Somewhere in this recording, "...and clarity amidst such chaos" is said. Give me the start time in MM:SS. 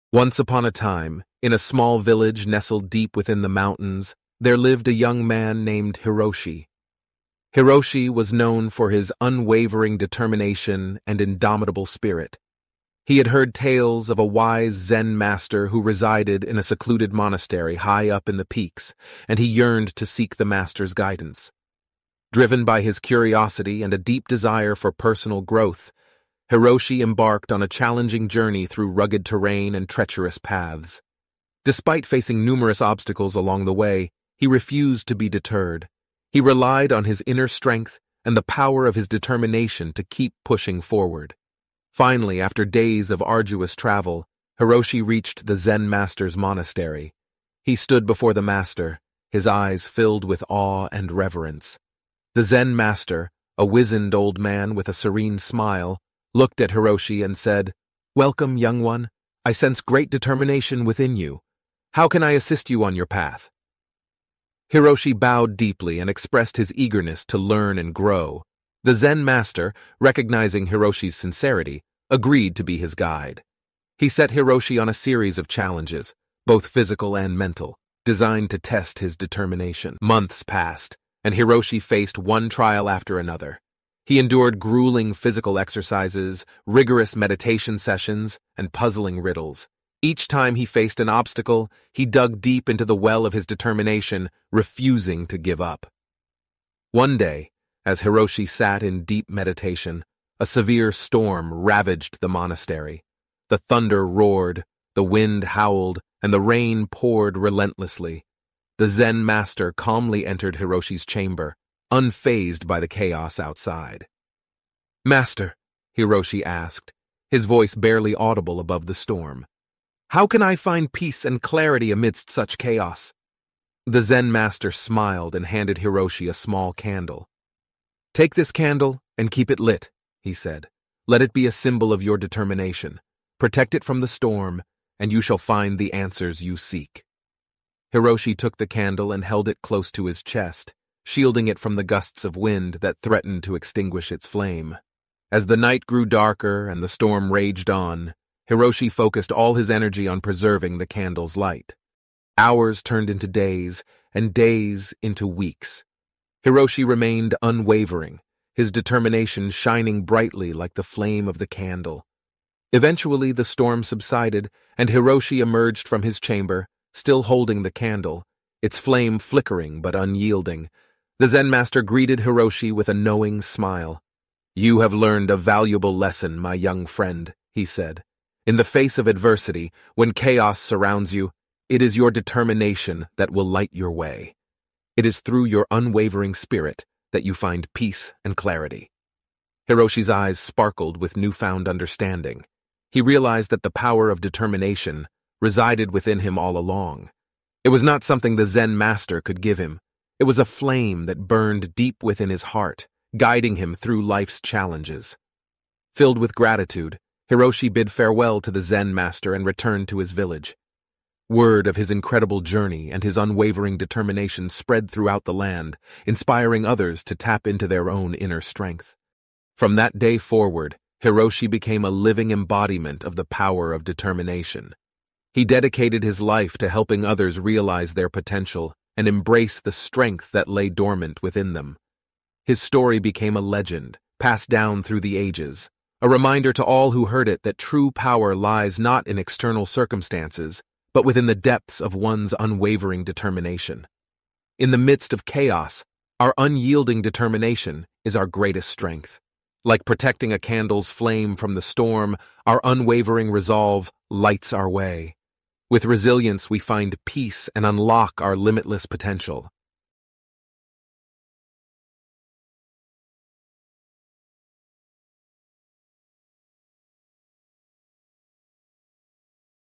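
02:01.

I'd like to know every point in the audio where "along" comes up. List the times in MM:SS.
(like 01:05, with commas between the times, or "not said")
00:33, 03:16.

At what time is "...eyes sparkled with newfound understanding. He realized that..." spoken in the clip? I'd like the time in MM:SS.
03:10.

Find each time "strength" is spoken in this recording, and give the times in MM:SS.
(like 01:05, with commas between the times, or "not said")
00:37, 03:38, 03:49, 04:08.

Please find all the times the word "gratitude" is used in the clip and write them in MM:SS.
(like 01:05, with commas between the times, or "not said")
03:26.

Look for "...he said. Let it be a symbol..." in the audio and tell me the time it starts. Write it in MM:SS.
02:10.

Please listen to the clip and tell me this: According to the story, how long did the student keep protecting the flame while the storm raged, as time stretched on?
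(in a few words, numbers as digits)
Weeks.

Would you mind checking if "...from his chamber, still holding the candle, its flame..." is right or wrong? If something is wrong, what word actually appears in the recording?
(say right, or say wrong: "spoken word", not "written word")
right.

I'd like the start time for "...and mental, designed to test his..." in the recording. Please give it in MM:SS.
01:17.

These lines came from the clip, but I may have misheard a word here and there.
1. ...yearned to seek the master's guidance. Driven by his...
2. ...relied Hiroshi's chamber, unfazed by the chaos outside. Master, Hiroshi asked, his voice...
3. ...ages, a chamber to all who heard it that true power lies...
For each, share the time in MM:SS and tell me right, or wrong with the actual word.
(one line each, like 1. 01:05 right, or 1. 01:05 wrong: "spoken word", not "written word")
1. 00:19 right
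2. 01:50 wrong: "entered", not "relied"
3. 03:55 wrong: "reminder", not "chamber".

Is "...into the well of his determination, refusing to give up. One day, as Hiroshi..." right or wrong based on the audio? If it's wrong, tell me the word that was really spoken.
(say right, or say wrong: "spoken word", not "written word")
right.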